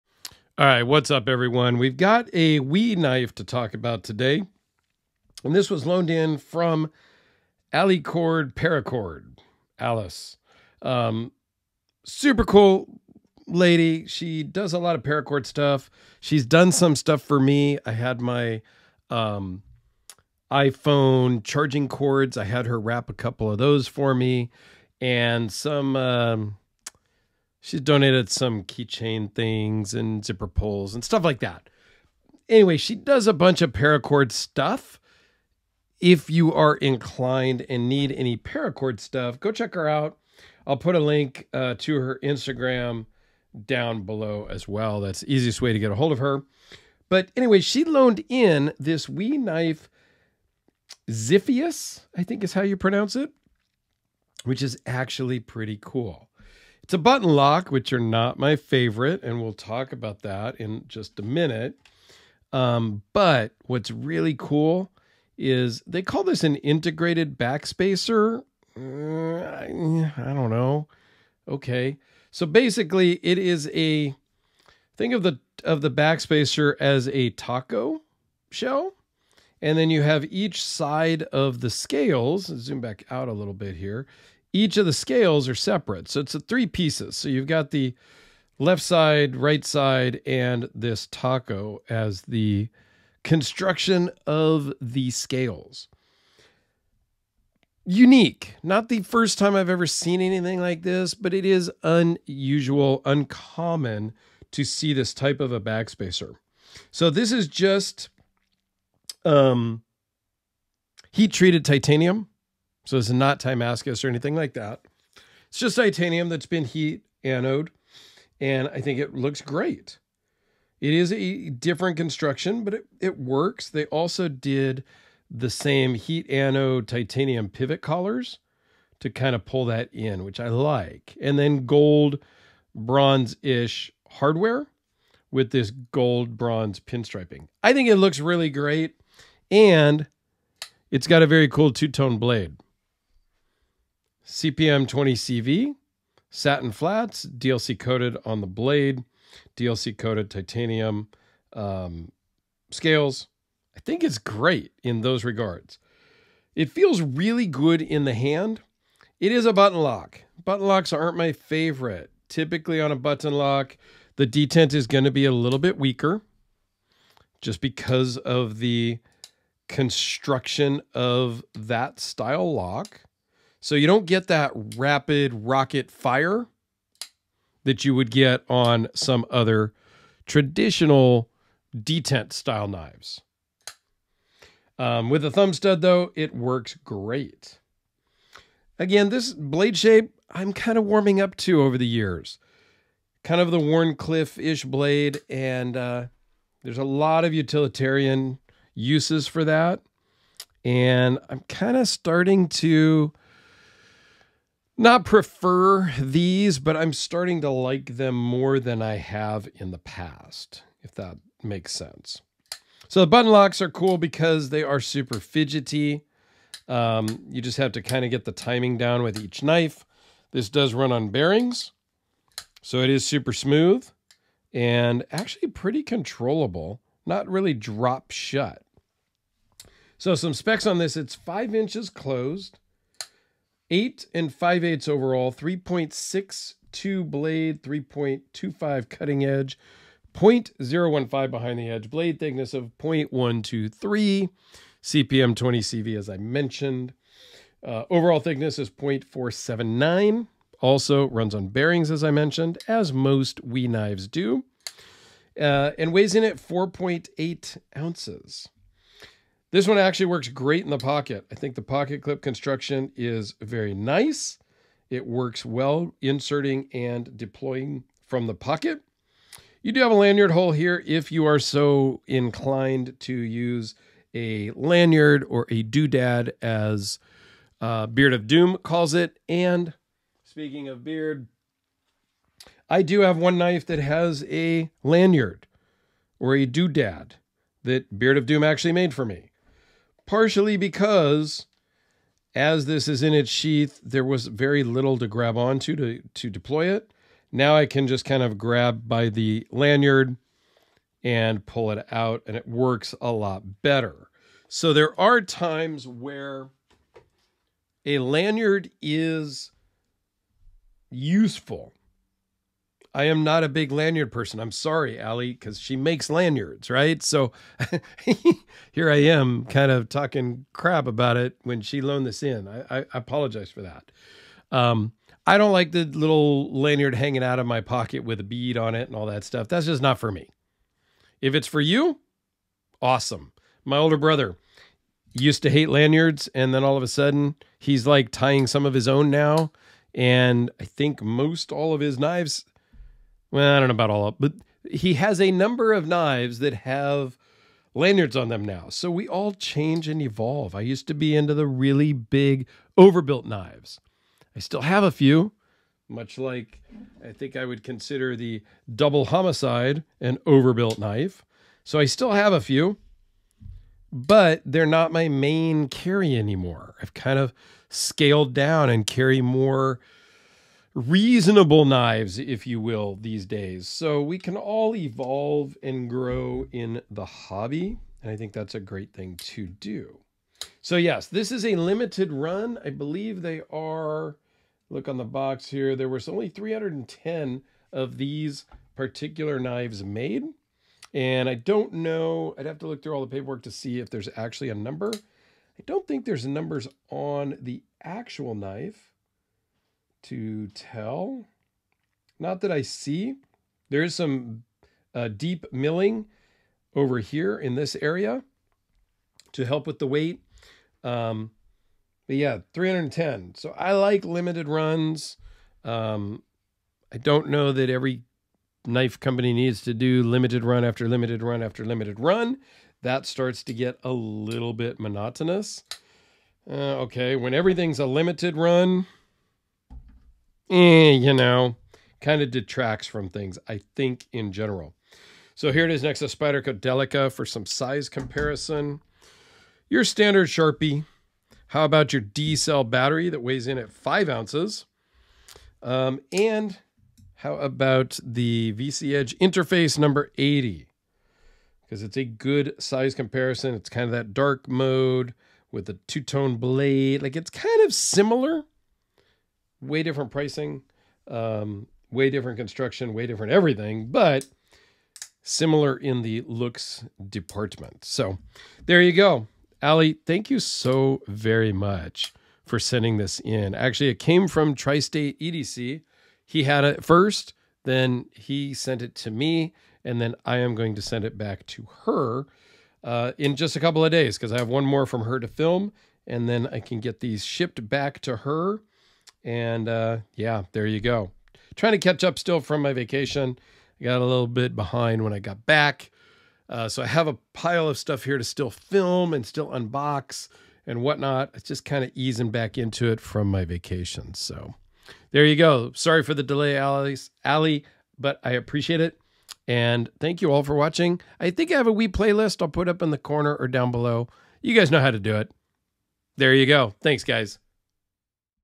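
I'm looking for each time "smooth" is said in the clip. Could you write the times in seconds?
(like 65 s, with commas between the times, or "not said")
223 s.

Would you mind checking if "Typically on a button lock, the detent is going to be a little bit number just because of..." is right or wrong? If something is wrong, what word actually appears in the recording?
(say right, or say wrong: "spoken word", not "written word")
wrong: "weaker", not "number".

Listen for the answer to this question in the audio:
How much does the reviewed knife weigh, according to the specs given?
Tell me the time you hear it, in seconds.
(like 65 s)
256 s.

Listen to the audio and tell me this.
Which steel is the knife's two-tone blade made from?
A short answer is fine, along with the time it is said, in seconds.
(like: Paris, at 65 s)
CPM 20CV, at 144 s.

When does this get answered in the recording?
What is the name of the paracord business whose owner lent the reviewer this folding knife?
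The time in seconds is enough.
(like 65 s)
7 s.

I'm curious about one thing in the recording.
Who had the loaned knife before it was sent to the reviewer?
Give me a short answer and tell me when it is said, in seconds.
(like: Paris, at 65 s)
Tri State EDC, at 474 s.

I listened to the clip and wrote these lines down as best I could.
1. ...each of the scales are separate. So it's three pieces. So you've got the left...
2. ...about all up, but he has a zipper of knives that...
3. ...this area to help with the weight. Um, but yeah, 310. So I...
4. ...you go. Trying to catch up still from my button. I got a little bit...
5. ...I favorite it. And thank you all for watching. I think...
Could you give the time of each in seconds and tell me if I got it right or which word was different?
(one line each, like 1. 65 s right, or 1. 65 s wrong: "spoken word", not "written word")
1. 84 s right
2. 343 s wrong: "number", not "zipper"
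3. 407 s right
4. 490 s wrong: "vacation", not "button"
5. 508 s wrong: "appreciate", not "favorite".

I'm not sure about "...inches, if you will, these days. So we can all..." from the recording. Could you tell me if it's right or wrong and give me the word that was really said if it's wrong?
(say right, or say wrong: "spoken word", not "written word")
wrong: "knives", not "inches".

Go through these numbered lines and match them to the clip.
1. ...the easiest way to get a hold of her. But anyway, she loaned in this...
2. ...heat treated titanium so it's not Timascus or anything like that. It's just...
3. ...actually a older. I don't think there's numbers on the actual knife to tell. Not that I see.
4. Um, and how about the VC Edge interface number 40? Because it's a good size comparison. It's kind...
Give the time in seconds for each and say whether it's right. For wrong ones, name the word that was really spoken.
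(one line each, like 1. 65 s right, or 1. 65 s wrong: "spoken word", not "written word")
1. 45 s right
2. 111 s right
3. 394 s wrong: "number", not "older"
4. 445 s wrong: "80", not "40".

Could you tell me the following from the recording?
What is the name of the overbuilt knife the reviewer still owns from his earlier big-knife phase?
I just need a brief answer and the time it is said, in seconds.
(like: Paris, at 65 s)
Double Homicide, at 358 s.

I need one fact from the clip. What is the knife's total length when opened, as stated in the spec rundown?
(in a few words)
8 5/8 inches.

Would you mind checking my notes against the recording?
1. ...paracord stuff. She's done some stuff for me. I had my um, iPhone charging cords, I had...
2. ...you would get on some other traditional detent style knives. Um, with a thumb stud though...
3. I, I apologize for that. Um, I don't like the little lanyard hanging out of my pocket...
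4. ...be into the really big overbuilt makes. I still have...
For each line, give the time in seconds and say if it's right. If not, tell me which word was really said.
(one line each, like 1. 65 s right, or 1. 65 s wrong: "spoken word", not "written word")
1. 15 s right
2. 177 s right
3. 322 s right
4. 350 s wrong: "knives", not "makes".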